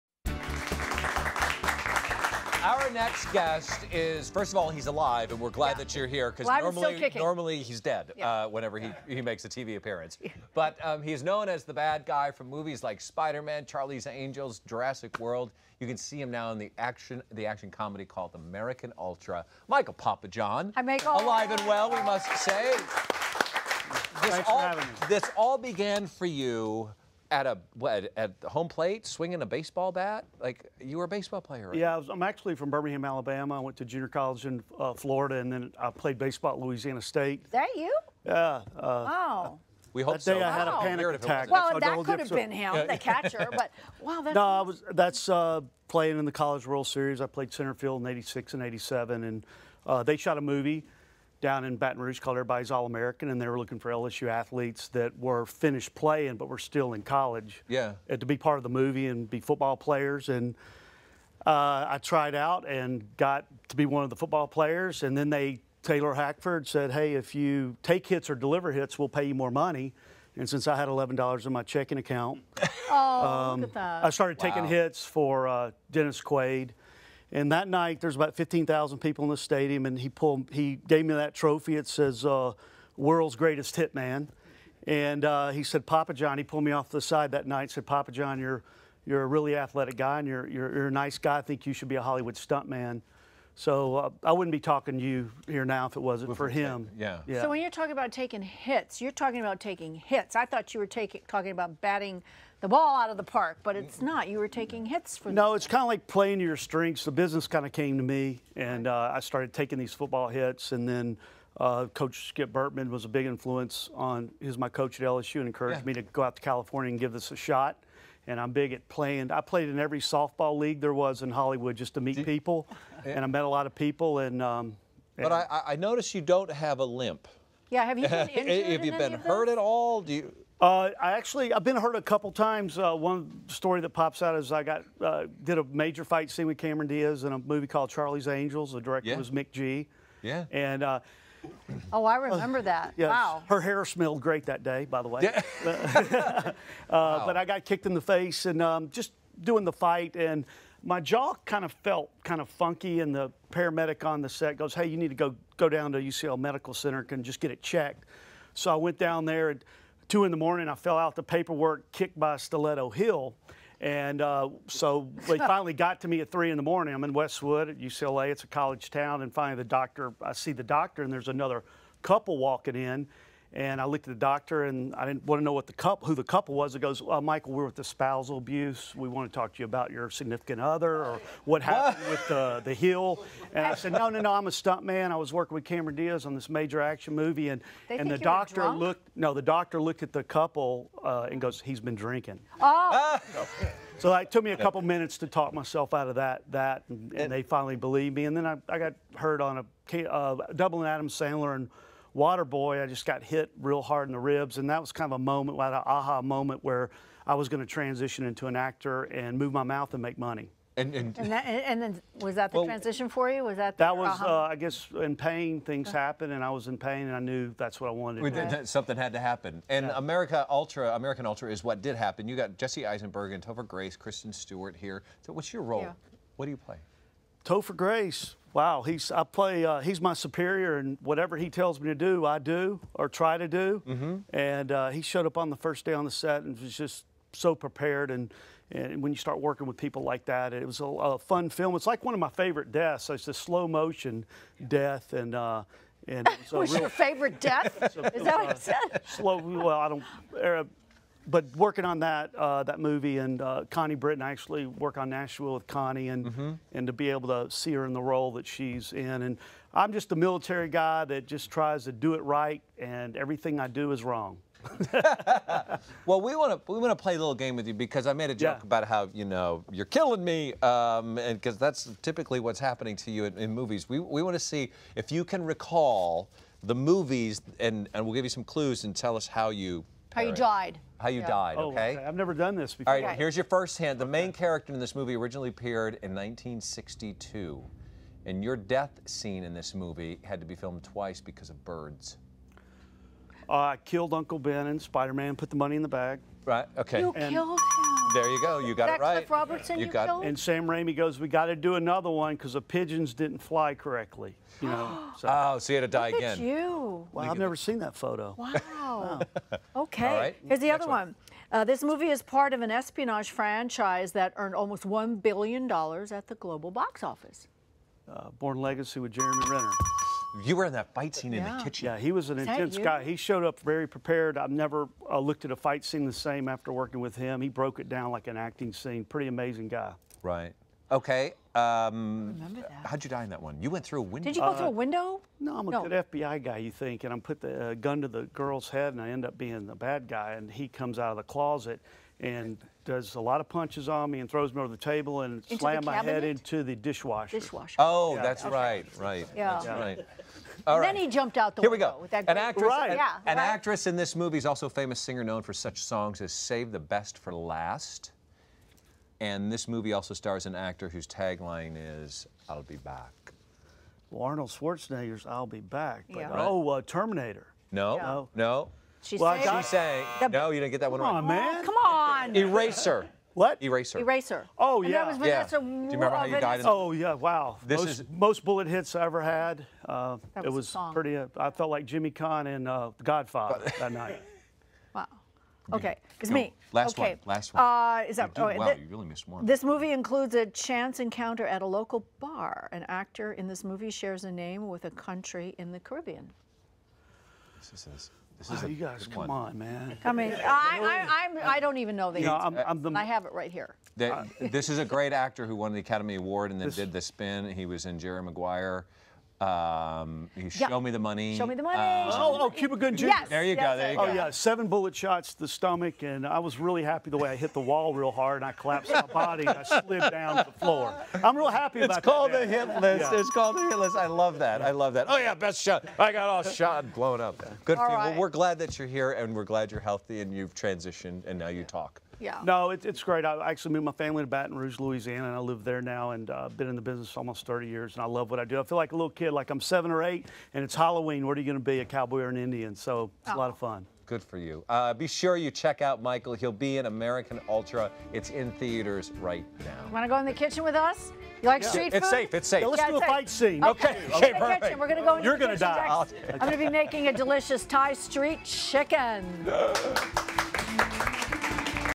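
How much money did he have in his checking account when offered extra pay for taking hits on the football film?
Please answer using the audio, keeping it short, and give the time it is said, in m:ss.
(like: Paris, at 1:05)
$11, at 1:10.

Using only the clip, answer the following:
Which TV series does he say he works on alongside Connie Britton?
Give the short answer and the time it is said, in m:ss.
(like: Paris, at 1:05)
Nashville, at 4:15.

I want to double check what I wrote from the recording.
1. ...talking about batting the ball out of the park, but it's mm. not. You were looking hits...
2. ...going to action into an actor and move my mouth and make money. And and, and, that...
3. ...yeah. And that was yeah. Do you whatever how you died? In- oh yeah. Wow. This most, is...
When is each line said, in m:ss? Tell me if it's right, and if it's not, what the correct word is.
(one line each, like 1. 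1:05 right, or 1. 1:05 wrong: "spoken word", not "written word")
1. 1:41 wrong: "taking", not "looking"
2. 3:27 wrong: "transition", not "action"
3. 6:14 wrong: "remember", not "whatever".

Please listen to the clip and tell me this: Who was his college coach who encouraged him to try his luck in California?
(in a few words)
Skip Bertman.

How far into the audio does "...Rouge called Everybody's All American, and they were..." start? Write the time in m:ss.
0:52.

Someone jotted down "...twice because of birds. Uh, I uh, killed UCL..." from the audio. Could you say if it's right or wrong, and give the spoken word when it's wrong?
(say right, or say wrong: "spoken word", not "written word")
wrong: "Uncle", not "UCL".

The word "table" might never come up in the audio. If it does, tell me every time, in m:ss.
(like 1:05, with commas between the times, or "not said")
5:44.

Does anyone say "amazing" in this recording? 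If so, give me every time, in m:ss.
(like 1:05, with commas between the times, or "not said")
5:29.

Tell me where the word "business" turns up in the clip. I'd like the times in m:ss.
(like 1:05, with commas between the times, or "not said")
1:47, 7:16.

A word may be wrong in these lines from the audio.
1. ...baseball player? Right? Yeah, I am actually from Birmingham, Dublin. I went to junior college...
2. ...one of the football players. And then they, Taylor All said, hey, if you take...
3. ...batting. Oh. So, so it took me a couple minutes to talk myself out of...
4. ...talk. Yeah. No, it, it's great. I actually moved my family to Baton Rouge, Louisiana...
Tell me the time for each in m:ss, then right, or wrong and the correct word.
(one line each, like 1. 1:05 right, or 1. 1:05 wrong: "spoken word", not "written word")
1. 0:31 wrong: "Alabama", not "Dublin"
2. 1:03 wrong: "Hackford", not "All"
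3. 3:11 wrong: "drinking", not "batting"
4. 7:11 right.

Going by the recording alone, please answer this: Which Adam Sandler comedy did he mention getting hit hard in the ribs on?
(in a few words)
Water Boy.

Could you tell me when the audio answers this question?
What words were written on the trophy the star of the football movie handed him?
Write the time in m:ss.
1:22.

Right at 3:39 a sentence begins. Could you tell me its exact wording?
America Ultra, American Ultra is what did happen.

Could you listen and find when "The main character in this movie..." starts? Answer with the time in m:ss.
4:43.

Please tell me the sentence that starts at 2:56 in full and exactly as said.
It goes, uh, Michael, we're with the spousal abuse.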